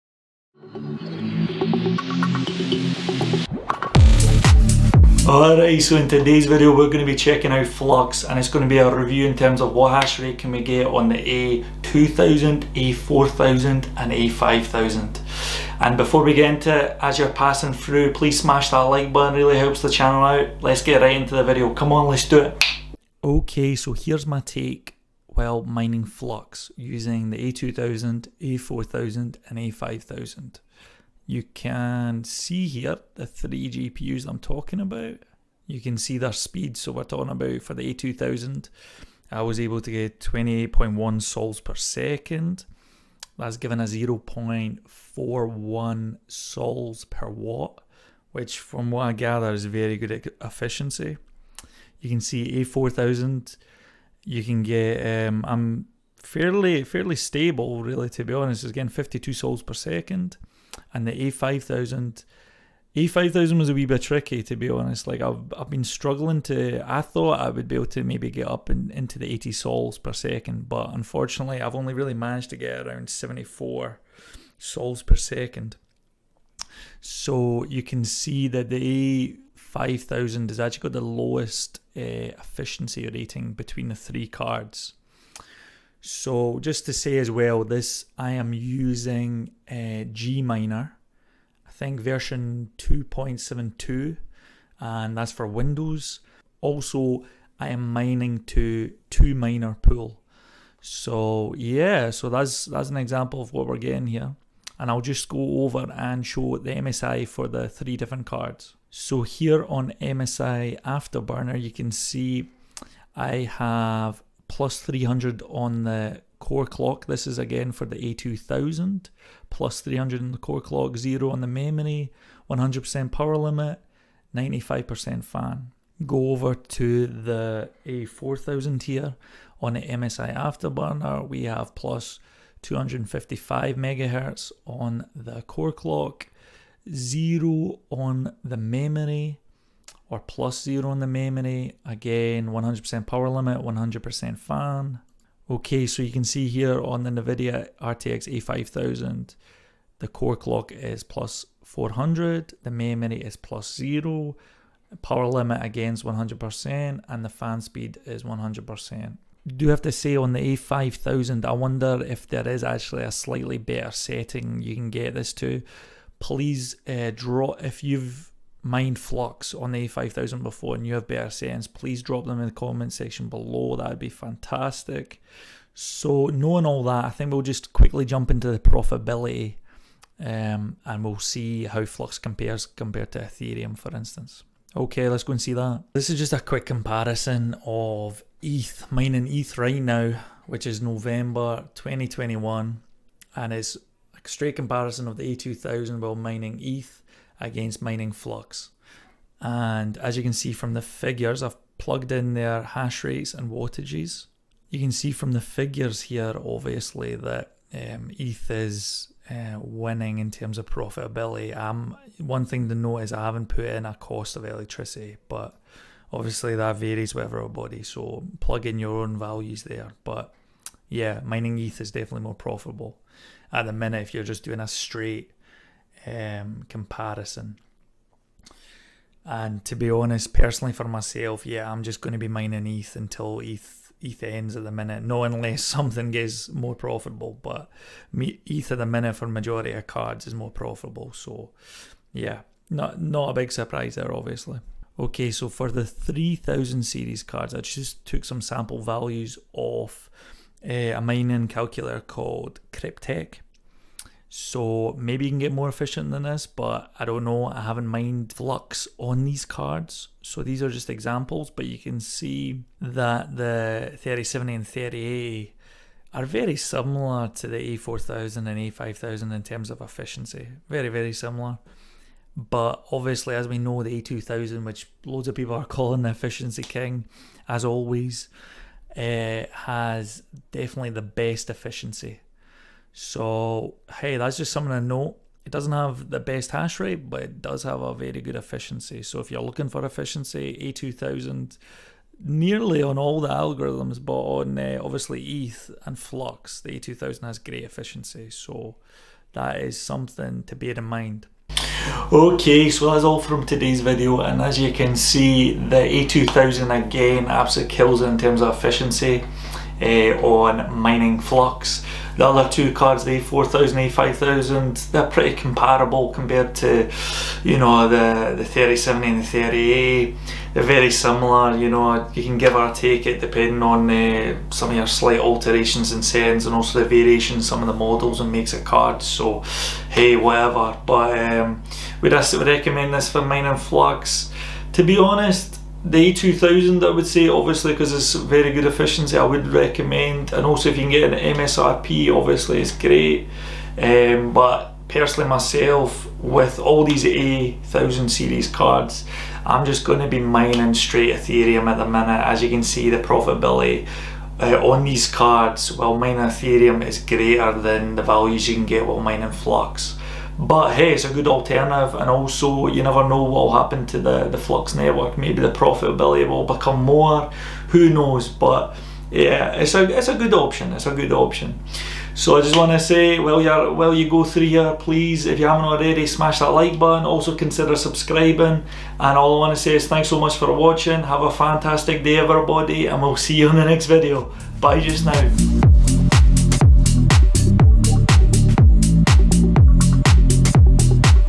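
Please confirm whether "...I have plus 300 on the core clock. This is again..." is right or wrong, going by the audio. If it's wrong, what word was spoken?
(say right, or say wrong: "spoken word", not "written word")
right.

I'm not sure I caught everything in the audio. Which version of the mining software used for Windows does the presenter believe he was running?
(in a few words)
2.72.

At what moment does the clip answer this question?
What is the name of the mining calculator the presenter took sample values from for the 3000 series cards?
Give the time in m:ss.
4:12.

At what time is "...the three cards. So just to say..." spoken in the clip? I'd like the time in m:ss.
1:23.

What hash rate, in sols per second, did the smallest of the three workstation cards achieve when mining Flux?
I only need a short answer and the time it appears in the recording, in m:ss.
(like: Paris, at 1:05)
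28.1 sols per second, at 0:40.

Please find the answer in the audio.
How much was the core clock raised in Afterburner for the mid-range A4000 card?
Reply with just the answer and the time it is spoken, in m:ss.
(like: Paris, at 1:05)
+255 MHz, at 2:11.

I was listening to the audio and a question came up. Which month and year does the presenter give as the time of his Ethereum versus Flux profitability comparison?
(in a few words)
November 2021.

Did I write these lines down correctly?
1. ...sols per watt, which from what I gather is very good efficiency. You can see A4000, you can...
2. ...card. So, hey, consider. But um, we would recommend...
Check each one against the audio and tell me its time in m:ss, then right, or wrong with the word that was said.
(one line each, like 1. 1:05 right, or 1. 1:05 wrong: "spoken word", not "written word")
1. 0:46 right
2. 5:28 wrong: "whatever", not "consider".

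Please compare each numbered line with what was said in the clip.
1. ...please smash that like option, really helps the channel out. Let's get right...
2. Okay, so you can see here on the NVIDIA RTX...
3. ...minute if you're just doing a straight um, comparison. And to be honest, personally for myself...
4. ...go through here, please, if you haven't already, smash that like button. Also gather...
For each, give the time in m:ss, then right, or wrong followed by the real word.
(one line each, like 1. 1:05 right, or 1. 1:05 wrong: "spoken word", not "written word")
1. 0:18 wrong: "button", not "option"
2. 2:25 right
3. 3:43 right
4. 6:14 wrong: "consider", not "gather".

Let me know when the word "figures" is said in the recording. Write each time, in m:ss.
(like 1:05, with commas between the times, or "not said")
3:20, 3:25.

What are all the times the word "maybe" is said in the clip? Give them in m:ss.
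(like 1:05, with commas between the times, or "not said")
1:08, 4:14, 6:05.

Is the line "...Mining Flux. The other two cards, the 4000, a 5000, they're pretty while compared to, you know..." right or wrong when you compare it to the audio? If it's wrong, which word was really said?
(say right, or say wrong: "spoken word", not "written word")
wrong: "comparable", not "while".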